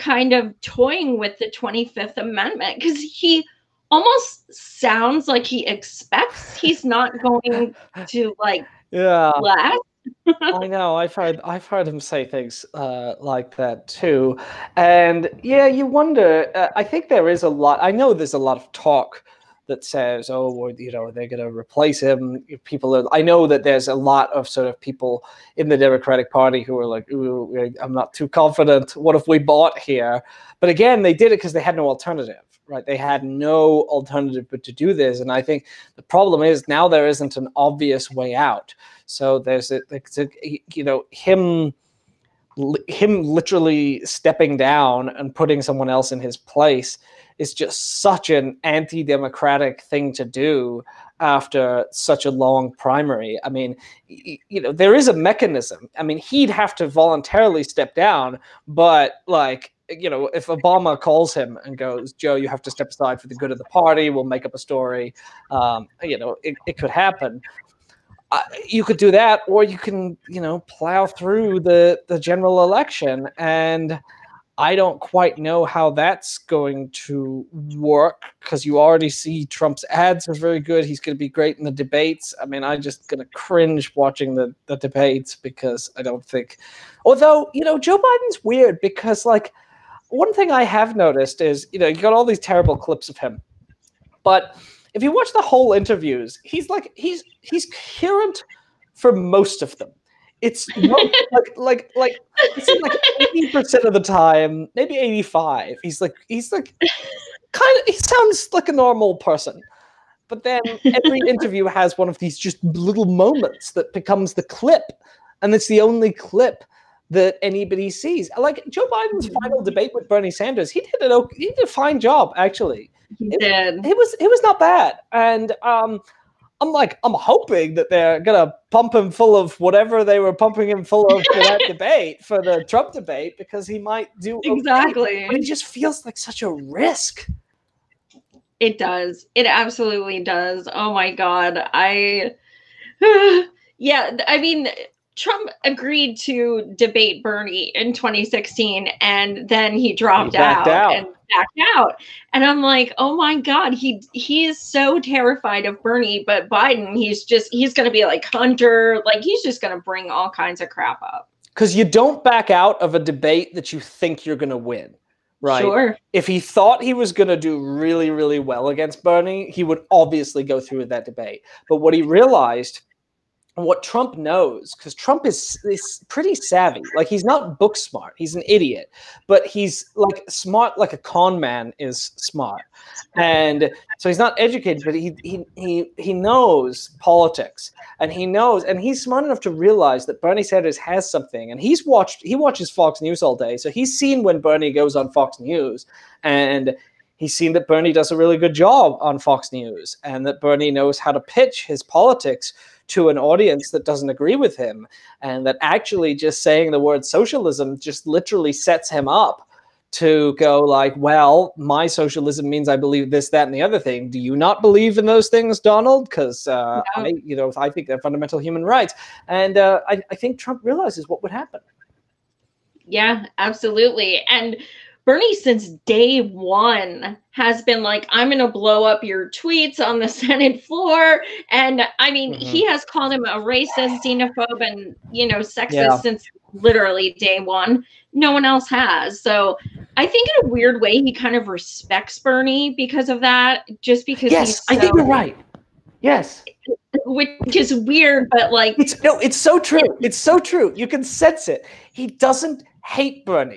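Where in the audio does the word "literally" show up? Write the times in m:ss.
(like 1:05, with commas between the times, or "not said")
0:43, 3:28, 3:56.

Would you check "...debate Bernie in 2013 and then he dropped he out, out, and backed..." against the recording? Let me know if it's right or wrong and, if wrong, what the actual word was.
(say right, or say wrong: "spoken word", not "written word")
wrong: "2016", not "2013".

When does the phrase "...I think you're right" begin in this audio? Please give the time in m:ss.
4:04.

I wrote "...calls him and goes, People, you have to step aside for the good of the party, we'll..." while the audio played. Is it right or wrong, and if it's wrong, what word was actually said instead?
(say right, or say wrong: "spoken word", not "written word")
wrong: "Joe", not "People".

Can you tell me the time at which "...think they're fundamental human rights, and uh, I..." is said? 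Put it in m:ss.
3:37.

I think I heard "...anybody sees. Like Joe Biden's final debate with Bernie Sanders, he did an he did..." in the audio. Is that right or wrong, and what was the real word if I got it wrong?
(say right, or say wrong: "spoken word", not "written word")
right.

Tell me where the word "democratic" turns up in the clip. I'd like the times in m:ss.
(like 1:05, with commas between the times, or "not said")
0:25, 0:48.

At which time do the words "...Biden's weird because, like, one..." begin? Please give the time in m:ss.
1:27.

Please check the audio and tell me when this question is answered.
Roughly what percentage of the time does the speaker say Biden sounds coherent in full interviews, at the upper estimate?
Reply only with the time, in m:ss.
1:44.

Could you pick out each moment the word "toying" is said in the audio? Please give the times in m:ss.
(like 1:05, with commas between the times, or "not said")
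0:00.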